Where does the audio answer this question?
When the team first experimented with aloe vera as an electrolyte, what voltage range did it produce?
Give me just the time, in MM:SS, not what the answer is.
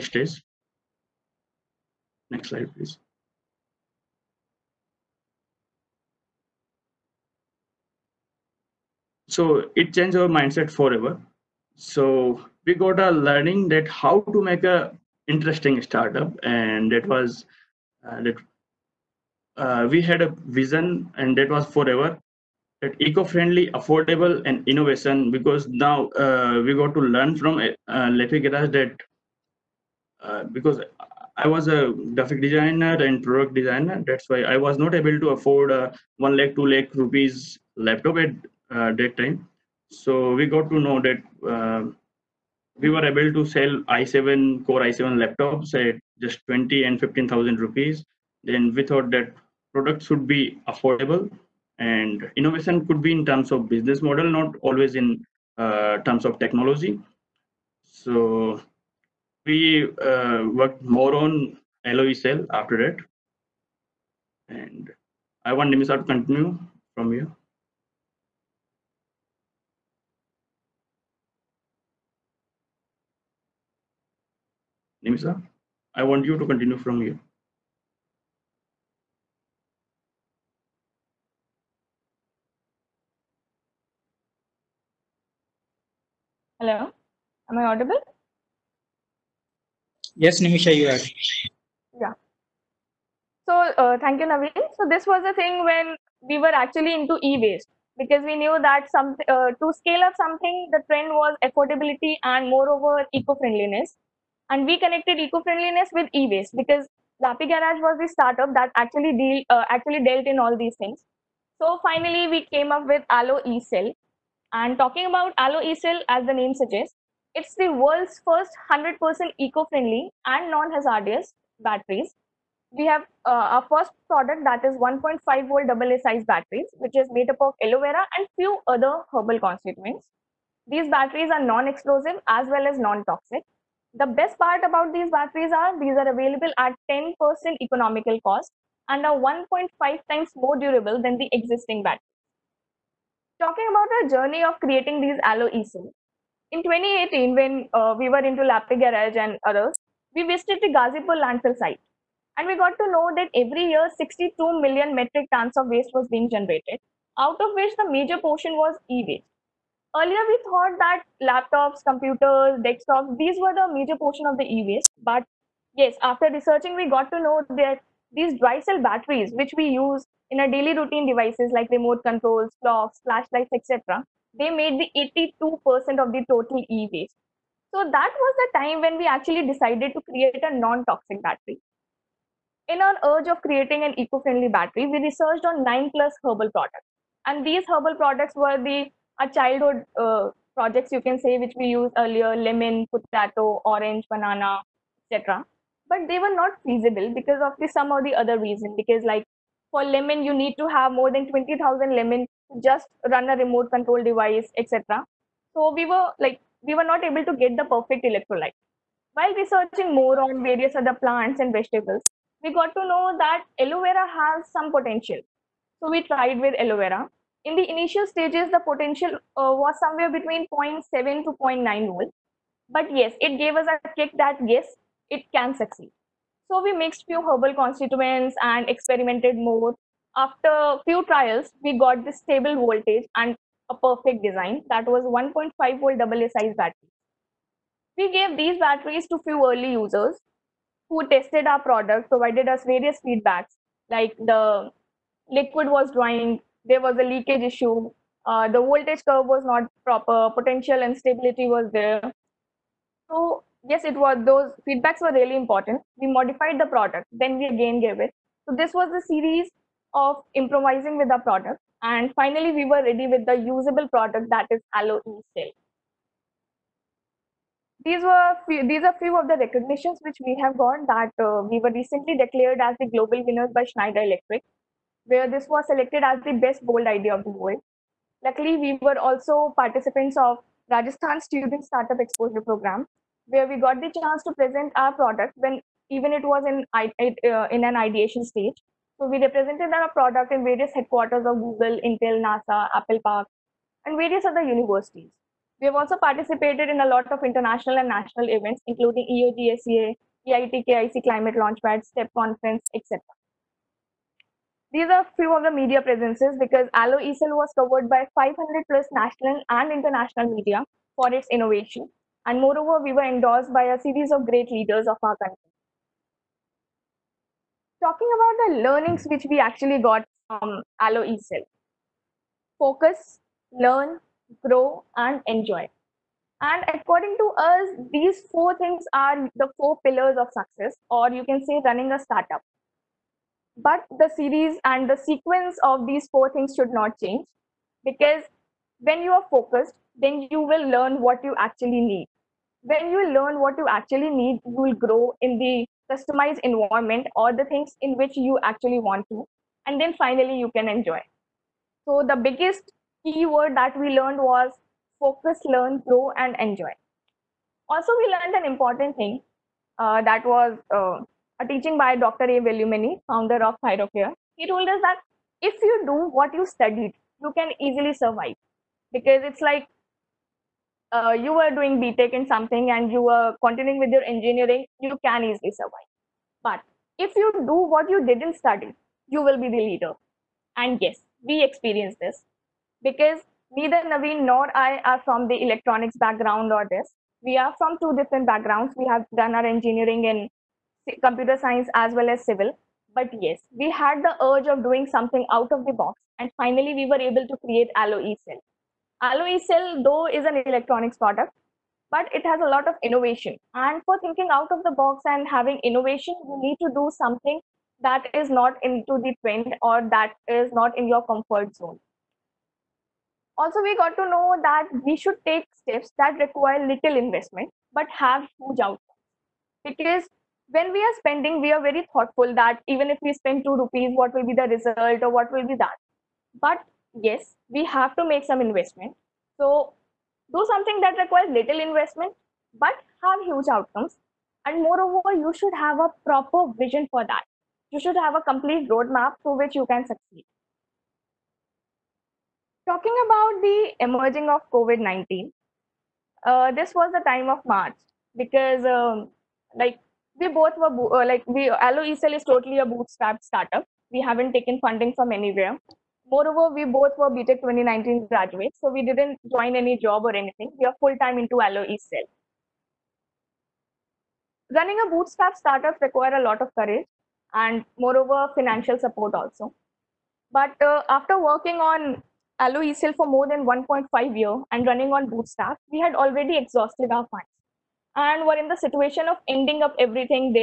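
03:40.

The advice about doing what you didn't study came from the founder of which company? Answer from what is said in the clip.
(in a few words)
Thyrocare.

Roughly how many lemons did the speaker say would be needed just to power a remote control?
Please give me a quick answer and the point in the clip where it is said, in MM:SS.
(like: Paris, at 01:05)
20000, at 03:21.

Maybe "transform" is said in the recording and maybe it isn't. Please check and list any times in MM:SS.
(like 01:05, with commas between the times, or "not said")
not said.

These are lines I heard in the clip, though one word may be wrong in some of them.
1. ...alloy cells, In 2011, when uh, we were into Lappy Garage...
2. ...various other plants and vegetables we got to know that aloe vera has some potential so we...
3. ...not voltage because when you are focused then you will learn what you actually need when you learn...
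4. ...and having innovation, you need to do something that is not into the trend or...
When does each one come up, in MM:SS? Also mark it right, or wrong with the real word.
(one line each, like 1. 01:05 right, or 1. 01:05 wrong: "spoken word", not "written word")
1. 02:25 wrong: "2018", not "2011"
2. 03:30 right
3. 05:36 wrong: "change", not "voltage"
4. 06:45 right.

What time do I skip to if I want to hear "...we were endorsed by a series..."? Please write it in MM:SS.
05:12.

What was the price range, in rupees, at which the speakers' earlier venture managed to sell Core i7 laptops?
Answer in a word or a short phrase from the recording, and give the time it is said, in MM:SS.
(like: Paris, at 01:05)
20 and 15,000 rupees, at 00:46.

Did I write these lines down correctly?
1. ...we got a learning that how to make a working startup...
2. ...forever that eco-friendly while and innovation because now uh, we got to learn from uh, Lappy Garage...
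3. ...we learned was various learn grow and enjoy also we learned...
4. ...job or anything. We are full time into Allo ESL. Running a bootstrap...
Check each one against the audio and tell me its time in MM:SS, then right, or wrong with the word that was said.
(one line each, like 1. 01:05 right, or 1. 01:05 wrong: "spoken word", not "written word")
1. 00:12 wrong: "interesting", not "working"
2. 00:21 wrong: "affordable", not "while"
3. 05:53 wrong: "focus", not "various"
4. 07:39 right.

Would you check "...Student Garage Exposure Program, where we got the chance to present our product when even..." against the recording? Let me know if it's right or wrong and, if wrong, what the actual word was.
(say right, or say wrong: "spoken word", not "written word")
wrong: "Startup", not "Garage".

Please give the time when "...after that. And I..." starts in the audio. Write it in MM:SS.
01:02.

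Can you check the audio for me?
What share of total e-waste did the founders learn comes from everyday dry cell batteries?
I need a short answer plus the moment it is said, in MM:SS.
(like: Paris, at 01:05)
82%, at 02:54.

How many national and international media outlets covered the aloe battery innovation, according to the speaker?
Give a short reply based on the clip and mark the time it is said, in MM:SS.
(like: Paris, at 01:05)
500 plus, at 05:08.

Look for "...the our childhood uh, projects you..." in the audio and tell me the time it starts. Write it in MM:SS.
03:08.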